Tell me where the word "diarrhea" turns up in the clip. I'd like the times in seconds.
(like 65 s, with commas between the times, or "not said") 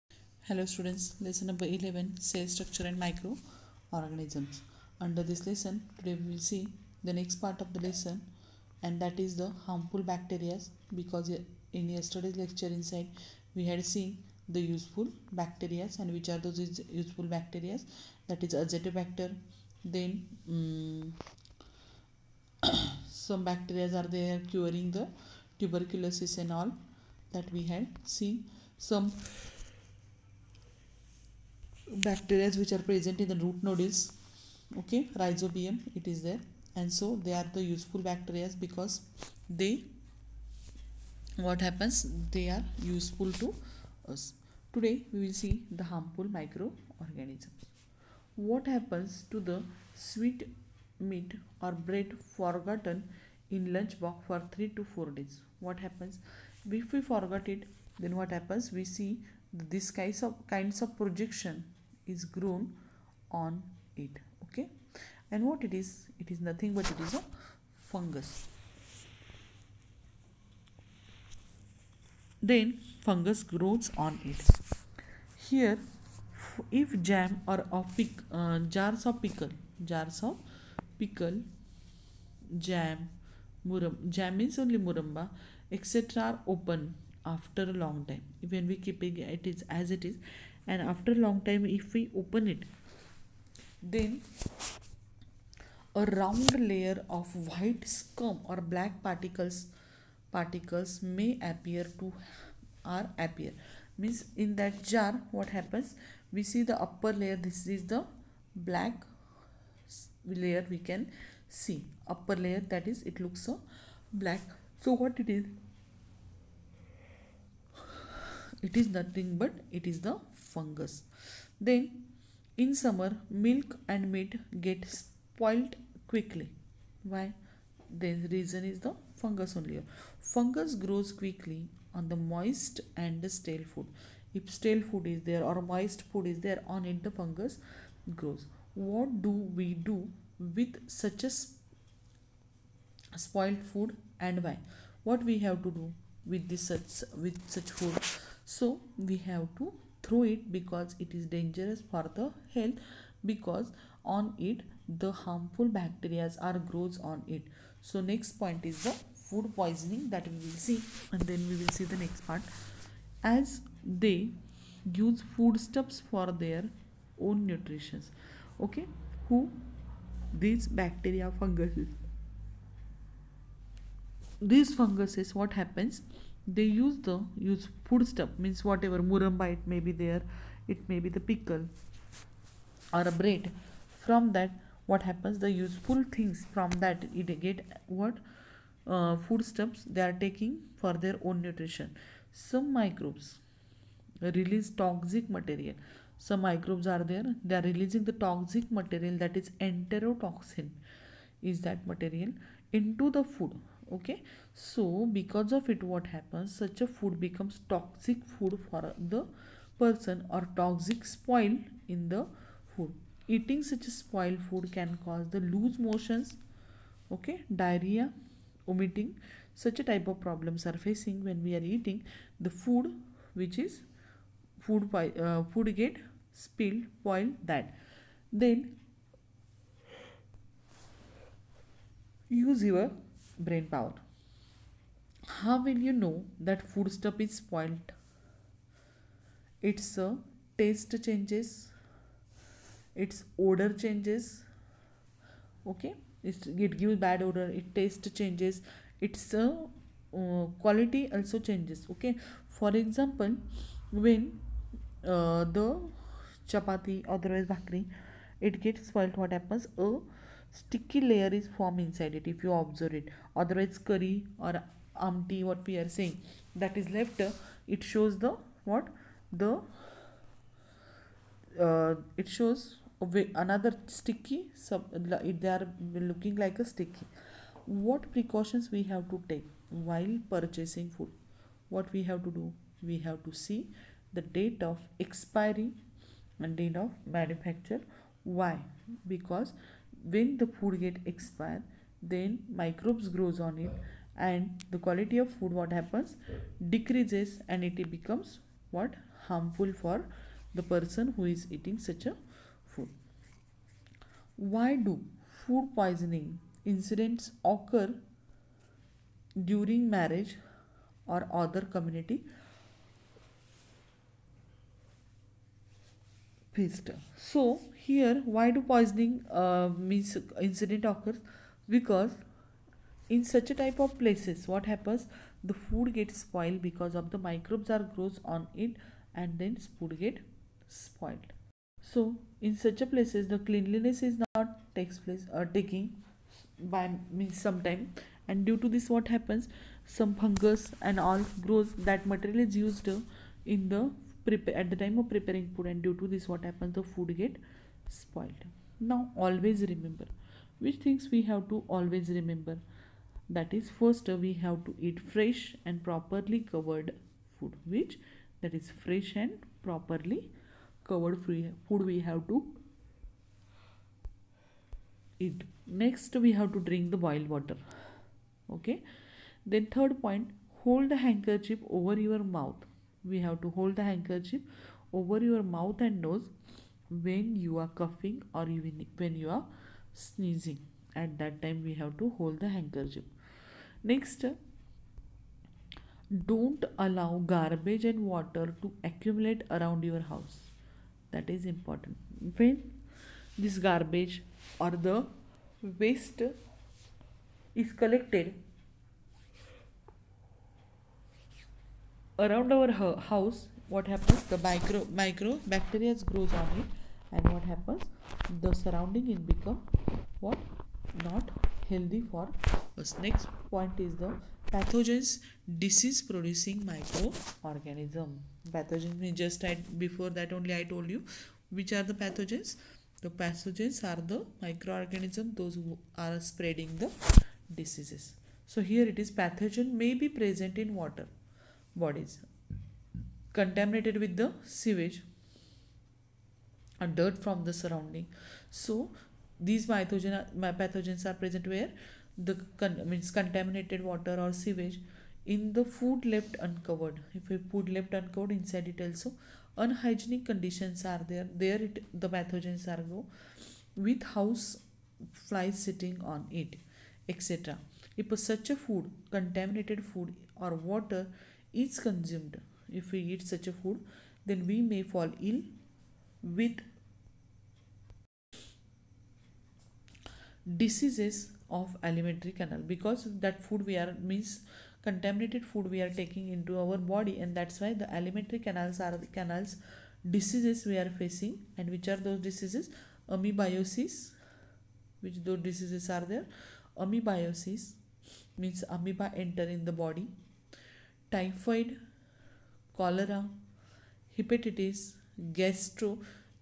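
217 s.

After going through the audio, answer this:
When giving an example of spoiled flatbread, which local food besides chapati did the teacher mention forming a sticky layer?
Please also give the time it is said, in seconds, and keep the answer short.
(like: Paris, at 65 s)
Bhakri, at 257 s.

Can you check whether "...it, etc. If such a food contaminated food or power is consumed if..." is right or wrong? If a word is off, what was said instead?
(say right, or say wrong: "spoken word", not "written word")
wrong: "water", not "power".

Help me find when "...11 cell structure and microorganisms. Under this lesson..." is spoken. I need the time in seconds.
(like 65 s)
1 s.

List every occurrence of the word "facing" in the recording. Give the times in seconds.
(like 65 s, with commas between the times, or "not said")
220 s, 480 s.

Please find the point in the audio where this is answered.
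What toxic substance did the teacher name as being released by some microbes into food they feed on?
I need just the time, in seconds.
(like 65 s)
199 s.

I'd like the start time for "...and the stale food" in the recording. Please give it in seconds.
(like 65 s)
132 s.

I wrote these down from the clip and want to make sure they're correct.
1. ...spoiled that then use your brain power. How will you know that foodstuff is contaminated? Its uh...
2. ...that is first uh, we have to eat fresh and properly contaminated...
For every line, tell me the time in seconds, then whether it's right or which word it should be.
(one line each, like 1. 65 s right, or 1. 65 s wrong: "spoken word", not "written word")
1. 226 s wrong: "spoiled", not "contaminated"
2. 353 s wrong: "covered", not "contaminated".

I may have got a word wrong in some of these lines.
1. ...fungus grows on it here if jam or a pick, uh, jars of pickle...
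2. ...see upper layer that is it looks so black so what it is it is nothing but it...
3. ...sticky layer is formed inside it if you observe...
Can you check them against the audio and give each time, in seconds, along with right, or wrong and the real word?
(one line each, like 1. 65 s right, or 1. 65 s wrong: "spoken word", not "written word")
1. 73 s right
2. 111 s right
3. 260 s right.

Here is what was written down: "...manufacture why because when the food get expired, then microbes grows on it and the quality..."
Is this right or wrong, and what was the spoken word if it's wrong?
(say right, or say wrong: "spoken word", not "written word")
right.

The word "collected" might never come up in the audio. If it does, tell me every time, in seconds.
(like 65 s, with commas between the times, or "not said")
397 s.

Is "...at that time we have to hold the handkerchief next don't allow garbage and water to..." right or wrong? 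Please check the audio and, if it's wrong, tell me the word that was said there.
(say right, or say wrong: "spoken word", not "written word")
right.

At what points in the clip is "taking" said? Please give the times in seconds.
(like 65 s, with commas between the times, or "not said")
190 s, 335 s, 475 s.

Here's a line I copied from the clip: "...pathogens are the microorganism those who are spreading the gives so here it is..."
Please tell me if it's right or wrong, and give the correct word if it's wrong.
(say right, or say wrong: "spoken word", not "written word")
wrong: "diseases", not "gives".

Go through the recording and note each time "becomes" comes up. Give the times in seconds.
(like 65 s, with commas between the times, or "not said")
207 s, 297 s, 409 s.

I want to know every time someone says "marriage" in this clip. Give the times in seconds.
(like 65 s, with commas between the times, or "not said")
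309 s.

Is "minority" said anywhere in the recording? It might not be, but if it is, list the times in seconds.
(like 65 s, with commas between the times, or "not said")
not said.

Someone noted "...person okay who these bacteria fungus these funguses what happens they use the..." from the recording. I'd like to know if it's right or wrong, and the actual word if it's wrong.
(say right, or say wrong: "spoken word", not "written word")
wrong: "nutrition", not "person".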